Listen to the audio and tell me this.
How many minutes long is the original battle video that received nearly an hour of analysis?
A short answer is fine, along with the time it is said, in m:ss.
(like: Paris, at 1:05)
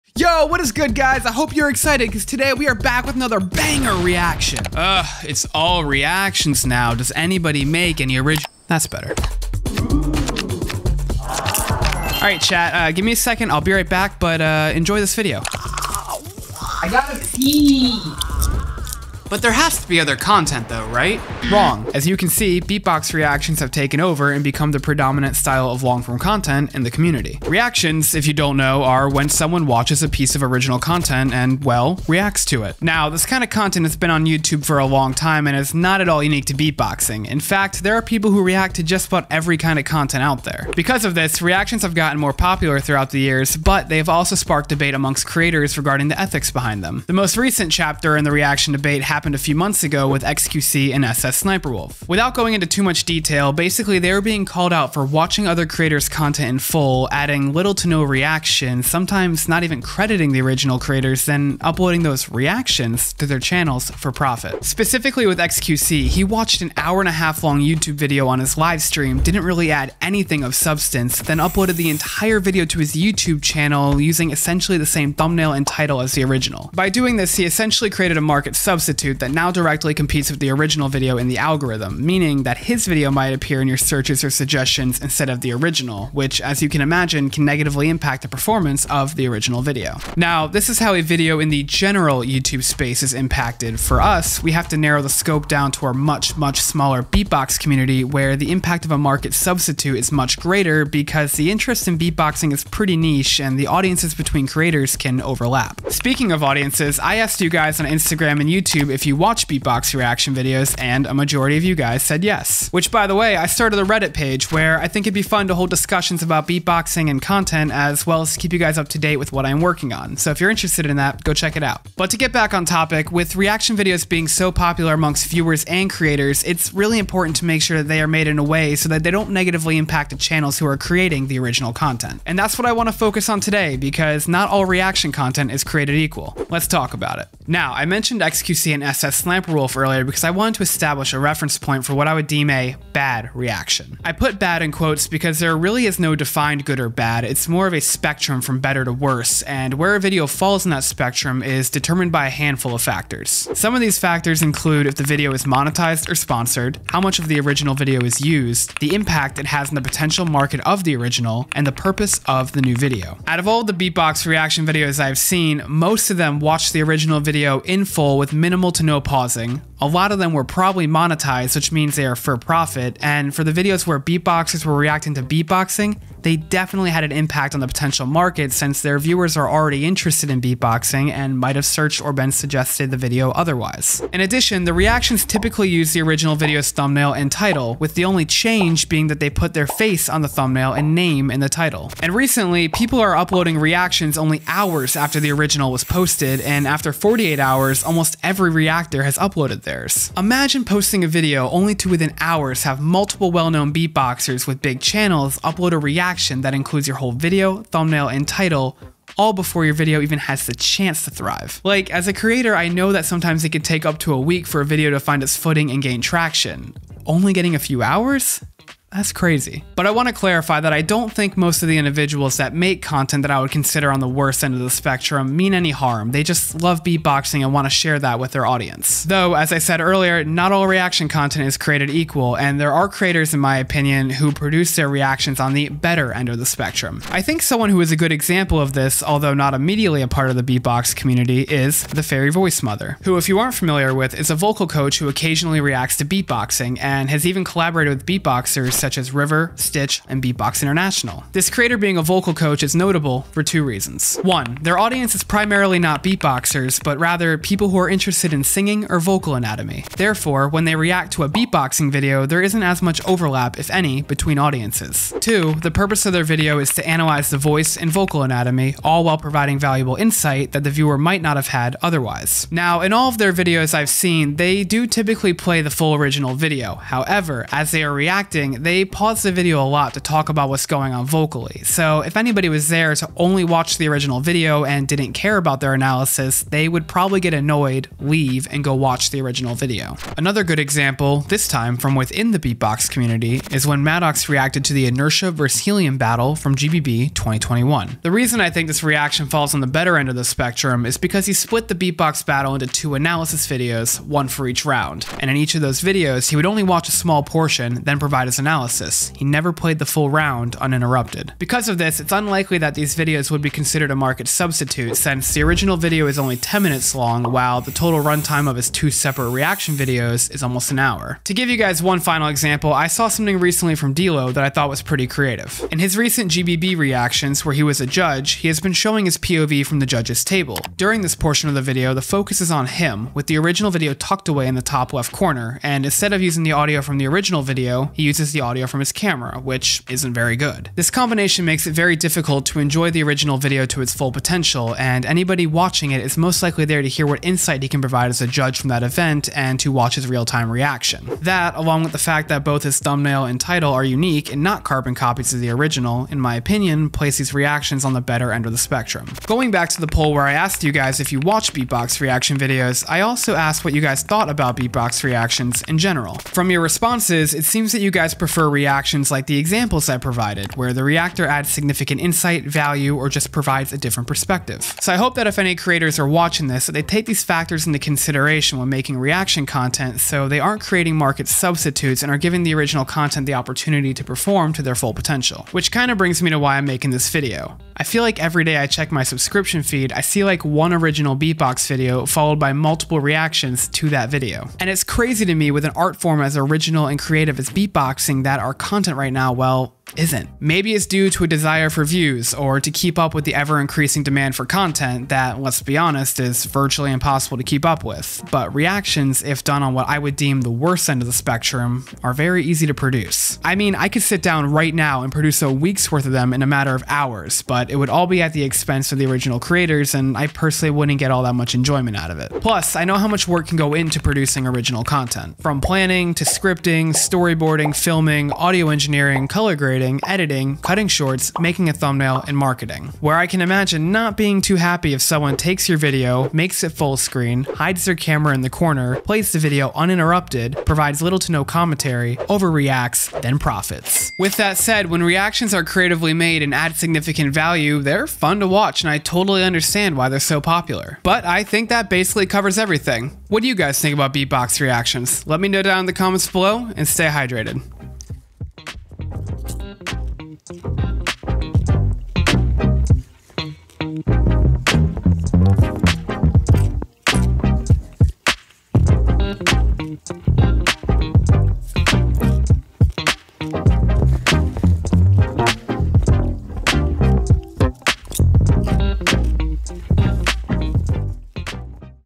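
10, at 5:16.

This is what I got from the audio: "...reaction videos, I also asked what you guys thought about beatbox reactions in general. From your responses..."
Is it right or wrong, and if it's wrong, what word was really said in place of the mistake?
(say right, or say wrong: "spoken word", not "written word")
right.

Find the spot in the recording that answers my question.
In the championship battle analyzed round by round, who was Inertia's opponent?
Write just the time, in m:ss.
4:55.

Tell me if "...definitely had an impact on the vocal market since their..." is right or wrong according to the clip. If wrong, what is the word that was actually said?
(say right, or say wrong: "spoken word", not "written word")
wrong: "potential", not "vocal".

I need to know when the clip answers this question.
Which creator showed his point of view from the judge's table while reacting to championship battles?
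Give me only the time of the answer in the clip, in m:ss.
5:23.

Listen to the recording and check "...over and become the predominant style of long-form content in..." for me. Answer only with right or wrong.
right.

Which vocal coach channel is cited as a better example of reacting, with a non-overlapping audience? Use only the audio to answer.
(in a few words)
The Fairy Voice Mother.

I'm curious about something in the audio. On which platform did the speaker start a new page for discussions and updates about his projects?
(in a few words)
Reddit.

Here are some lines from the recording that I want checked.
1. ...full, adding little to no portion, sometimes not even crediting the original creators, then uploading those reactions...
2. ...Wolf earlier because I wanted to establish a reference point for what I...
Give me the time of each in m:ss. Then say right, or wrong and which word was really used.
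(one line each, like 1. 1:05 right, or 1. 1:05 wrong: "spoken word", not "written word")
1. 0:56 wrong: "reaction", not "portion"
2. 2:19 right.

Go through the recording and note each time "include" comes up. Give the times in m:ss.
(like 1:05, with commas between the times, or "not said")
2:34, 3:26.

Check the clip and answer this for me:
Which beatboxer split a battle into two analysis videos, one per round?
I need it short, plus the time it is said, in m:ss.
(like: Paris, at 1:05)
Maddox, at 4:53.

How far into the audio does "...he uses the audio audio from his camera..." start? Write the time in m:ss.
5:37.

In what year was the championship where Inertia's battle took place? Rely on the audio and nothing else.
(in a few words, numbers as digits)
2021.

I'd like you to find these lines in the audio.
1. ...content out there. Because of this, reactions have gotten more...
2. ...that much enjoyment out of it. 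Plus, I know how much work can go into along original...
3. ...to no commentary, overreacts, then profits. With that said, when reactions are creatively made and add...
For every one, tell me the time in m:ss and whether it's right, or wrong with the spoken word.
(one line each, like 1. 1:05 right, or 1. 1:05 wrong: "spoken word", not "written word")
1. 0:39 right
2. 7:01 wrong: "producing", not "along"
3. 7:21 right.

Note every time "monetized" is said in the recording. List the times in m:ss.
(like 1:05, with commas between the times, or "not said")
2:35, 2:50.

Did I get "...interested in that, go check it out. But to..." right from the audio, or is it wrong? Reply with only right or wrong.
right.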